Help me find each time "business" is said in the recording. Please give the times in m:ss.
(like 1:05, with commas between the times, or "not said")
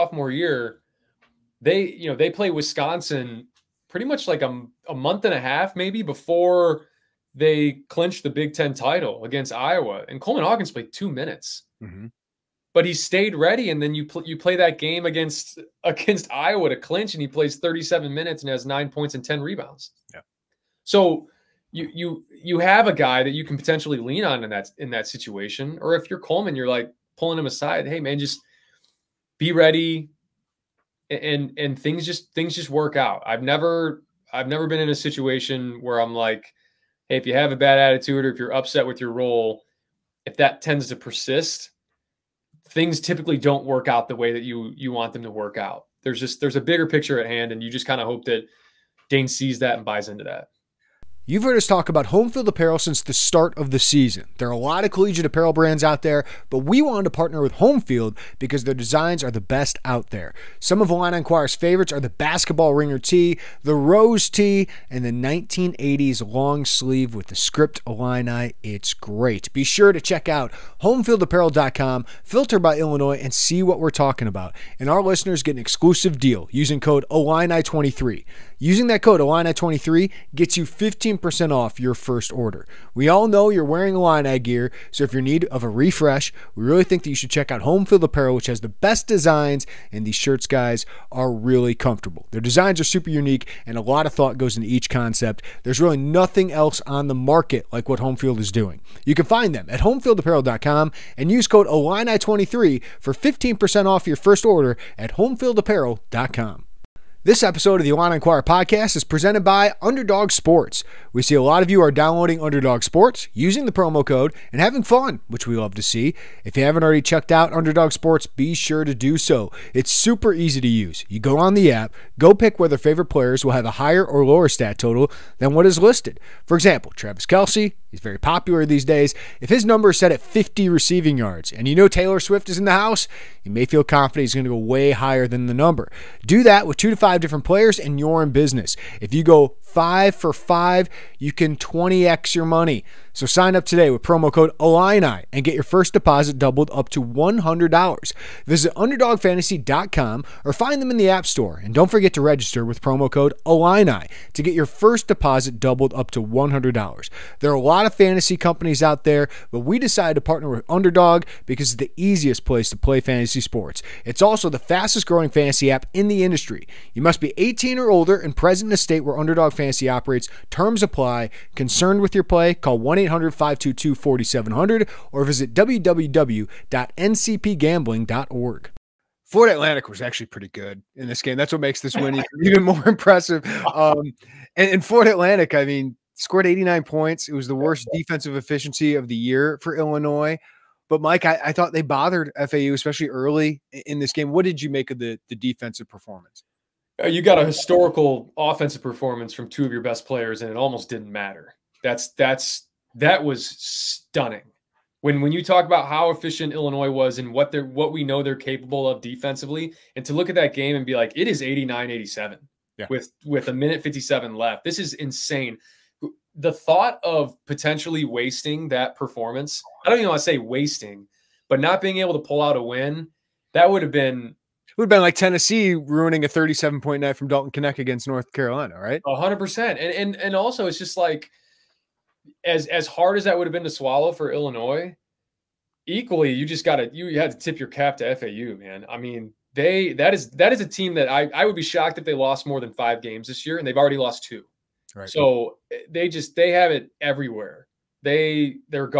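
2:18.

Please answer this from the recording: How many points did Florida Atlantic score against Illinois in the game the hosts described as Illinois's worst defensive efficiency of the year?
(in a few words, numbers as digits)
89.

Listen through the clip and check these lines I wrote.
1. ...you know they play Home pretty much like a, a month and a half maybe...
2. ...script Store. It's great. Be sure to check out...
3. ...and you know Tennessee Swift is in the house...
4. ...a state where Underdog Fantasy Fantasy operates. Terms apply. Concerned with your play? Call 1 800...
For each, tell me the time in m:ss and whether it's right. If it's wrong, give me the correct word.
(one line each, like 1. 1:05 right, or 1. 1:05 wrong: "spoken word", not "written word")
1. 0:01 wrong: "Wisconsin", not "Home"
2. 1:07 wrong: "Illini", not "Store"
3. 2:11 wrong: "Taylor", not "Tennessee"
4. 2:48 right.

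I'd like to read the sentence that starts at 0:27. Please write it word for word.
Hey man, just be ready, and and things just things just work out.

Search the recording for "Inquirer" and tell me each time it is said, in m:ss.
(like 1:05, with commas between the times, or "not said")
1:01, 1:48.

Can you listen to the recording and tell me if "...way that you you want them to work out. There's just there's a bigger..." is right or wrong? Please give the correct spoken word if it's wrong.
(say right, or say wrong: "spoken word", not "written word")
right.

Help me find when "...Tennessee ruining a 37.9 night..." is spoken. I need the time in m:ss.
3:45.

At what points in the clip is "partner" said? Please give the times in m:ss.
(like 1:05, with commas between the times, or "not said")
0:57, 2:40.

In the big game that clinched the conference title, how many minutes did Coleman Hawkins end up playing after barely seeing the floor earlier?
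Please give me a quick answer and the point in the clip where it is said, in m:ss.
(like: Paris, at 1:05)
37, at 0:17.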